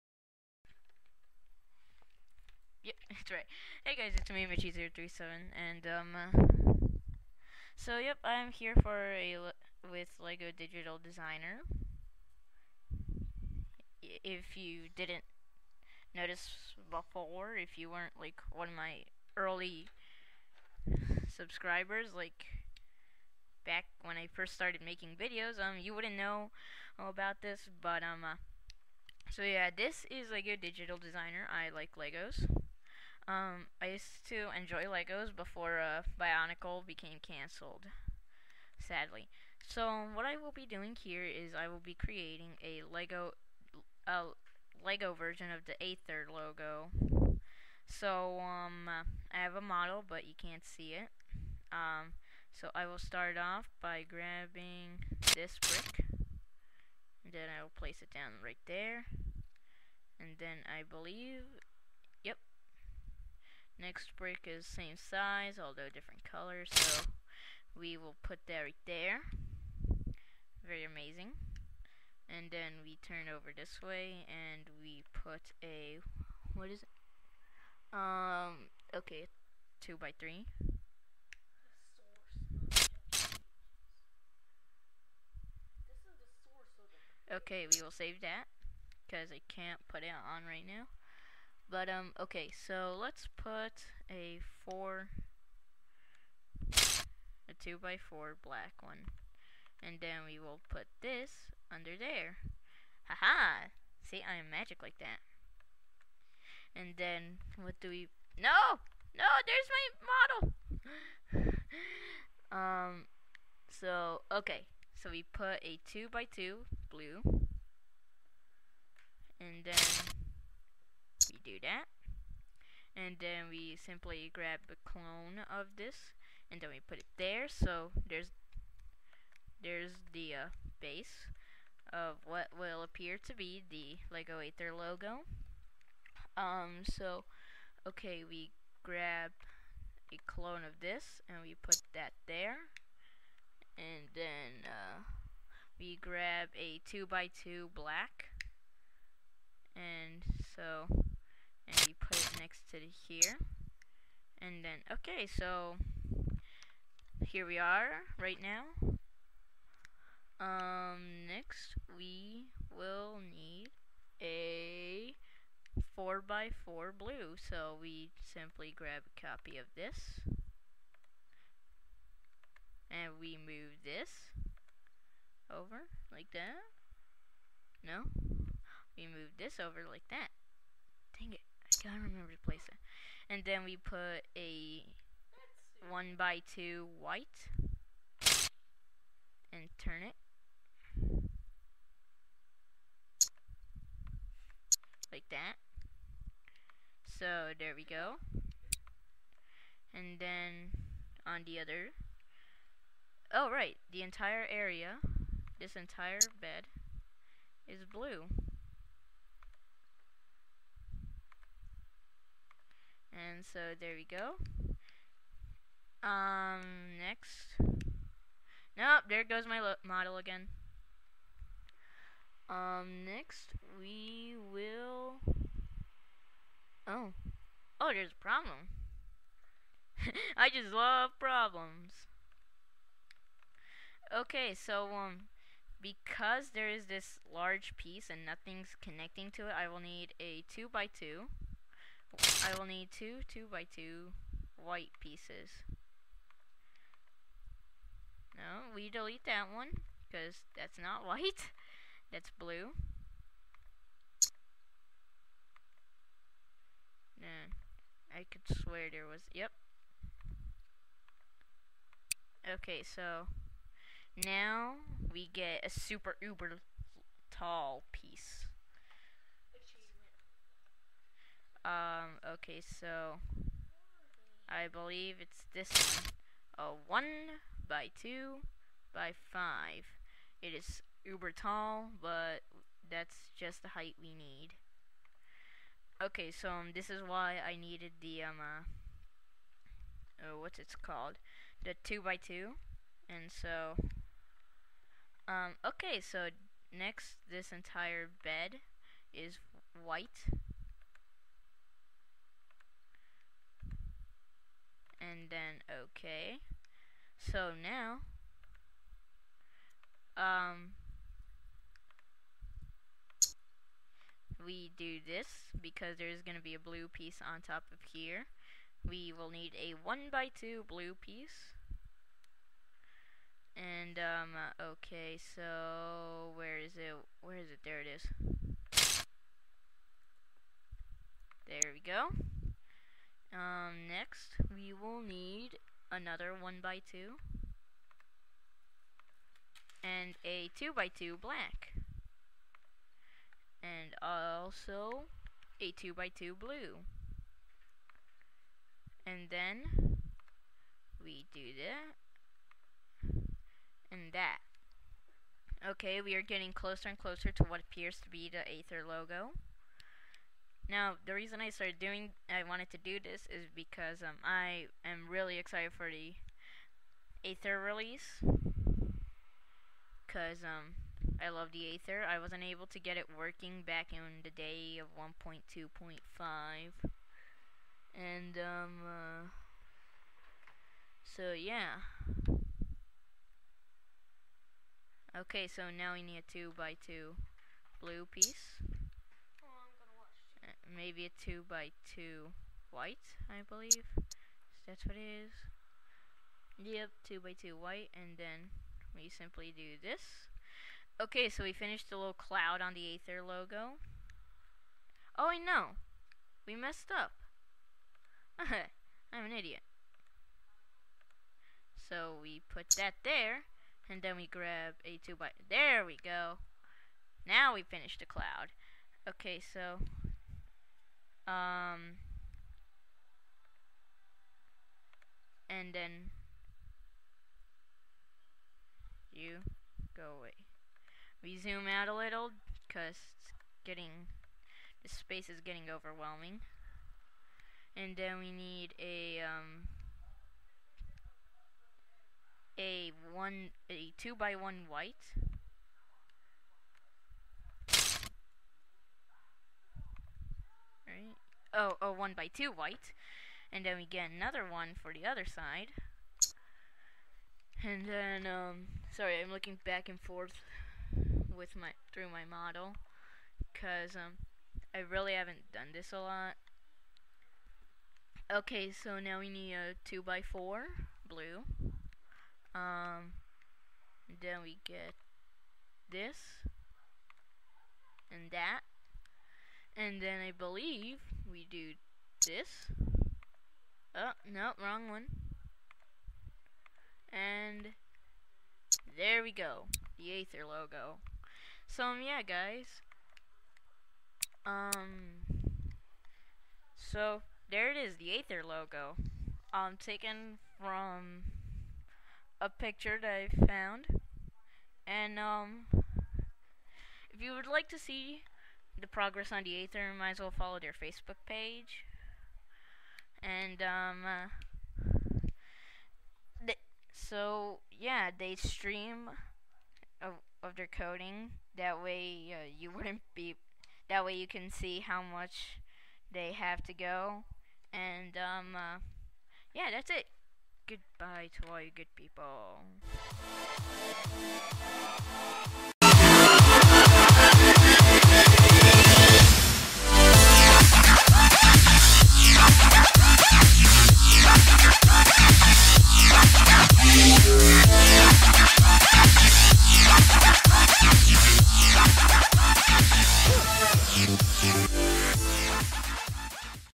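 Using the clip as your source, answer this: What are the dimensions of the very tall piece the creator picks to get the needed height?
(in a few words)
1 by 2 by 5.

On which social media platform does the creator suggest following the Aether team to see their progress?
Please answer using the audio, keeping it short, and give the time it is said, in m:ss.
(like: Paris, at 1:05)
Facebook, at 8:30.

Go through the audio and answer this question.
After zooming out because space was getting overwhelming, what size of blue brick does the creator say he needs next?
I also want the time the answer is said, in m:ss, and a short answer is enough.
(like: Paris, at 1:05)
2 by 4, at 7:49.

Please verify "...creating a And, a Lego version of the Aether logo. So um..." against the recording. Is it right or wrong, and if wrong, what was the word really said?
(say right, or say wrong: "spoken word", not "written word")
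wrong: "Lego", not "And".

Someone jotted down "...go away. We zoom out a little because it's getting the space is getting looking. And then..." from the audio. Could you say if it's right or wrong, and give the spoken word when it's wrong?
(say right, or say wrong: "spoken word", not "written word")
wrong: "overwhelming", not "looking".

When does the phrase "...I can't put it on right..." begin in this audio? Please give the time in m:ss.
1:29.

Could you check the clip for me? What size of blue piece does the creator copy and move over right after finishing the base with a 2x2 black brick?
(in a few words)
4x4.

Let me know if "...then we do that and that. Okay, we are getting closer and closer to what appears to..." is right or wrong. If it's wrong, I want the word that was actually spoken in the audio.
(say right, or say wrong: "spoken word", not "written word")
right.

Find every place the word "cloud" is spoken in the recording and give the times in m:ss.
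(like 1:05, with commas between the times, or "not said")
6:42, 6:58.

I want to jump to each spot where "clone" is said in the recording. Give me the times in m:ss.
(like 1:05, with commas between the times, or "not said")
2:04, 2:20.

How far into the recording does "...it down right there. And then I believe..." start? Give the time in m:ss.
0:58.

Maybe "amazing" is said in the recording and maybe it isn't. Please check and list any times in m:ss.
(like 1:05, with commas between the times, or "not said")
1:10.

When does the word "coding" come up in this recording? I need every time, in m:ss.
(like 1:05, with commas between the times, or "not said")
8:40.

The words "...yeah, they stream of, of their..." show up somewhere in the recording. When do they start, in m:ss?
8:37.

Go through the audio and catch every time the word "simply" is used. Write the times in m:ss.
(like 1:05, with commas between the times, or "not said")
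2:03, 2:48, 6:39.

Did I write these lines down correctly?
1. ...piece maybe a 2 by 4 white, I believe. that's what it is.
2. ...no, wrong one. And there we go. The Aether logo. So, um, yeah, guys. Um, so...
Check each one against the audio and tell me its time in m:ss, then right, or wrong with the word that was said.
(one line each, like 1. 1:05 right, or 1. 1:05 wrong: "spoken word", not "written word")
1. 6:28 wrong: "2", not "4"
2. 8:04 right.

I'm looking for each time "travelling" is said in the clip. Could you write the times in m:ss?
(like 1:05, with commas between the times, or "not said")
not said.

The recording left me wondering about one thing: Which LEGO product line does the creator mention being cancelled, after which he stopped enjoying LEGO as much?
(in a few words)
Bionicle.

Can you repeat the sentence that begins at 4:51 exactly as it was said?
The 2 by 2 And so, um, okay, so next, this entire bed is white and then okay.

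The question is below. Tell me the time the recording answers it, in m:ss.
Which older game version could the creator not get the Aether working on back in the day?
6:14.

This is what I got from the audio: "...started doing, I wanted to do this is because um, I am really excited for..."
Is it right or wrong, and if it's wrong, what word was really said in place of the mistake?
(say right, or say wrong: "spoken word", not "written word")
right.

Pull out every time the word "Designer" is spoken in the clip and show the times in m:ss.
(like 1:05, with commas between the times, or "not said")
0:11, 0:30.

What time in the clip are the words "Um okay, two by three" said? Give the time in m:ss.
1:17.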